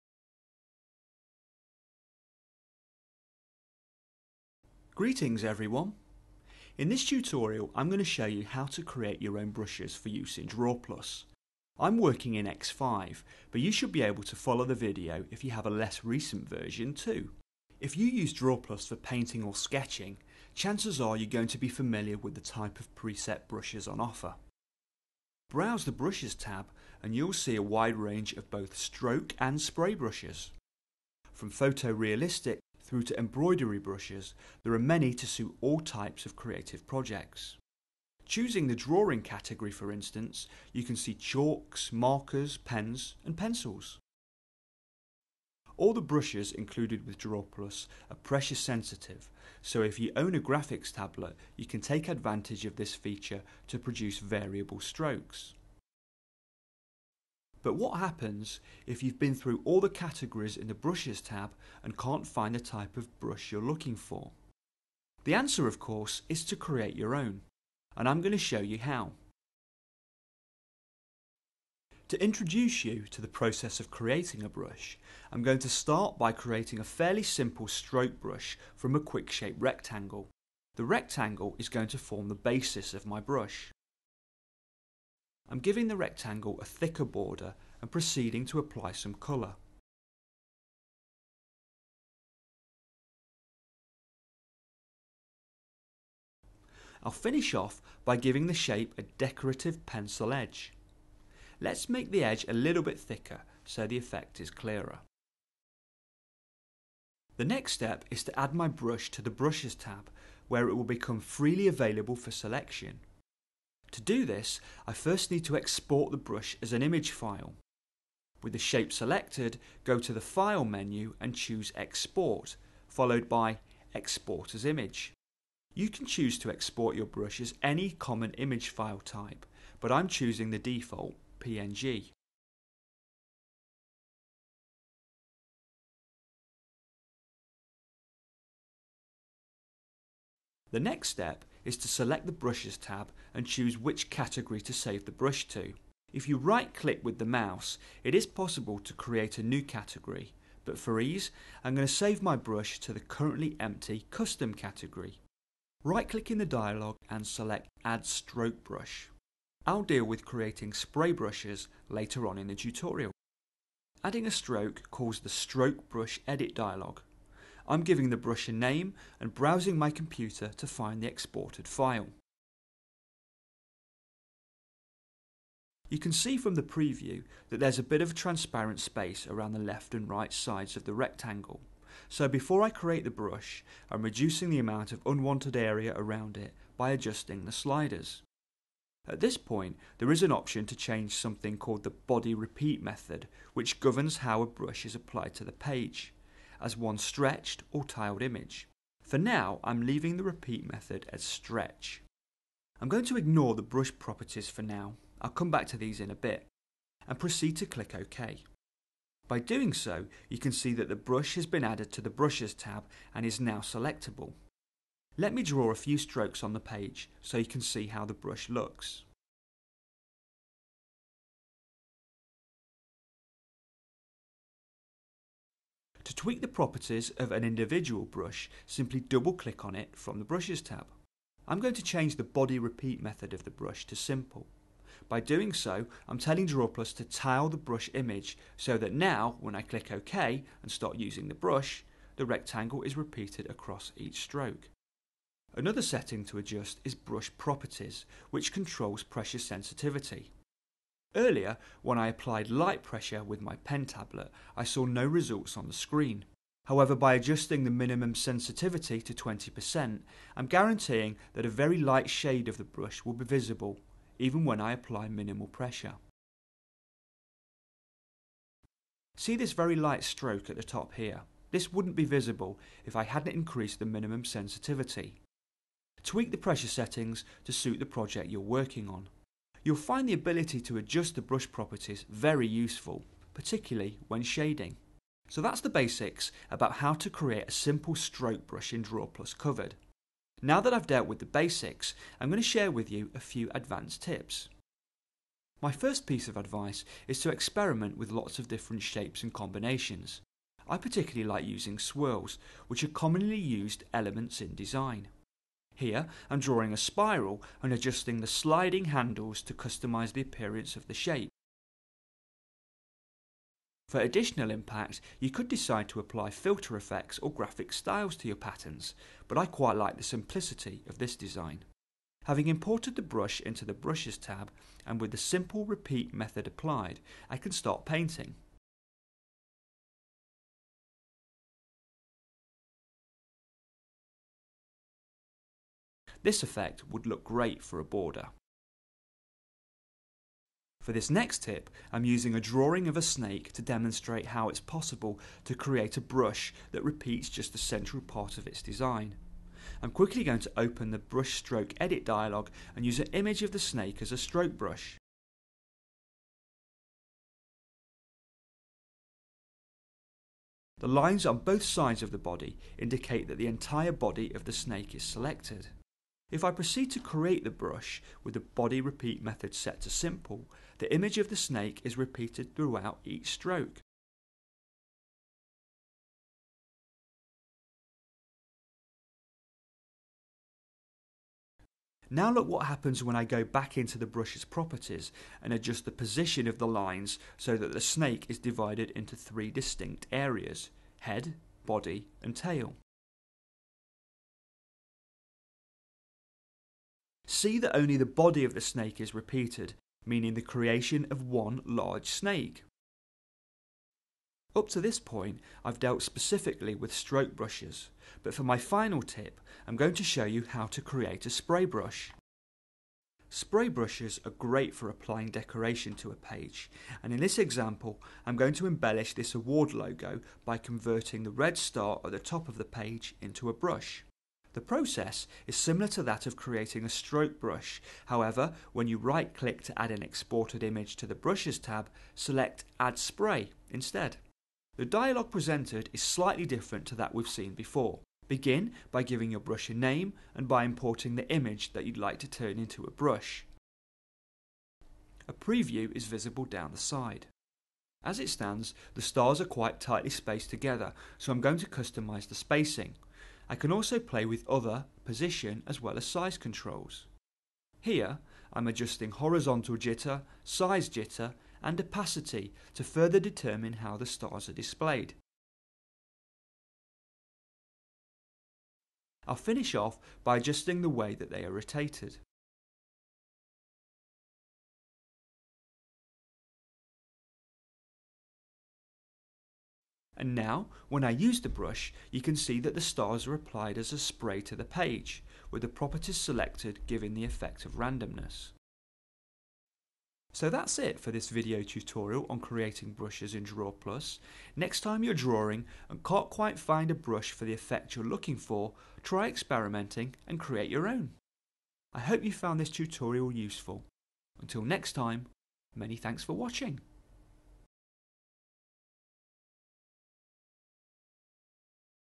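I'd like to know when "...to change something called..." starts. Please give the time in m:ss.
3:10.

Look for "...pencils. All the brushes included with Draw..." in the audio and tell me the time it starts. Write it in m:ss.
0:43.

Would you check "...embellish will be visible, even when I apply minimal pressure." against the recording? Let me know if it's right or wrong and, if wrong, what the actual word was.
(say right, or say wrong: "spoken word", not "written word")
wrong: "brush", not "embellish".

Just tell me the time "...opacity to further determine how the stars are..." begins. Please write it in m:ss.
7:41.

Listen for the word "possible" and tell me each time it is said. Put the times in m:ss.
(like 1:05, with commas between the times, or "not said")
2:28, 5:44.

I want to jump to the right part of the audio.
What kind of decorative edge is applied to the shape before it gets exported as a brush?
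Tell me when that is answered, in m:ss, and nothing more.
1:39.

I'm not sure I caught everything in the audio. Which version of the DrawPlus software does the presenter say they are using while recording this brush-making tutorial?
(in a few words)
X5.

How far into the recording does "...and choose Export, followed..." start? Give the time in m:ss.
2:01.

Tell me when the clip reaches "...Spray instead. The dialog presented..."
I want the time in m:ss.
7:12.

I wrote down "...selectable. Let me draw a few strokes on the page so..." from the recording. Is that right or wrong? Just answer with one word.
right.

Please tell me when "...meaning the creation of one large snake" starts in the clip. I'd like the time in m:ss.
6:40.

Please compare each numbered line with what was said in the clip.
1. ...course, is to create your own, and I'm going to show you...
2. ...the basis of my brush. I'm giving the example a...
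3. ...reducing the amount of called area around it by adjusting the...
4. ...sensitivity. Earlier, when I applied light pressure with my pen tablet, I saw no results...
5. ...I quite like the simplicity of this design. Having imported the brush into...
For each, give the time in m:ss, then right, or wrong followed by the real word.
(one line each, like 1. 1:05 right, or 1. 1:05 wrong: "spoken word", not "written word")
1. 1:05 right
2. 1:22 wrong: "rectangle", not "example"
3. 3:04 wrong: "unwanted", not "called"
4. 4:09 right
5. 5:19 right.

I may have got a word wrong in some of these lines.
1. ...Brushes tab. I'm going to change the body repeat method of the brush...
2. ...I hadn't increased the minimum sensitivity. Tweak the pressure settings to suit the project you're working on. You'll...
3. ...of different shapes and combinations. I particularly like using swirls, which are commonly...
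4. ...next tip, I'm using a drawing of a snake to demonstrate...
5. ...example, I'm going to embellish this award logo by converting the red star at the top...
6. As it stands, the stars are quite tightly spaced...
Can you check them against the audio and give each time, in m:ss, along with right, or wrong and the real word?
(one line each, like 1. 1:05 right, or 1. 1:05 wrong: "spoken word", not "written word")
1. 3:50 right
2. 4:32 right
3. 4:58 right
4. 5:41 right
5. 6:57 right
6. 7:28 right.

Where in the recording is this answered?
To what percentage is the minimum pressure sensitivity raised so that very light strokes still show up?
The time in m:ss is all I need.
4:19.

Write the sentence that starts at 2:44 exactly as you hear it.
Adding a stroke calls the Stroke Brush Edit dialog.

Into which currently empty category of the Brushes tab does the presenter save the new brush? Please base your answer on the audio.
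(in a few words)
Custom.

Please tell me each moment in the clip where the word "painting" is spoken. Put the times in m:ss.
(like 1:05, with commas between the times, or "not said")
0:18, 5:27.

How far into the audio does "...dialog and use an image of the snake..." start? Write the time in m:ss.
5:52.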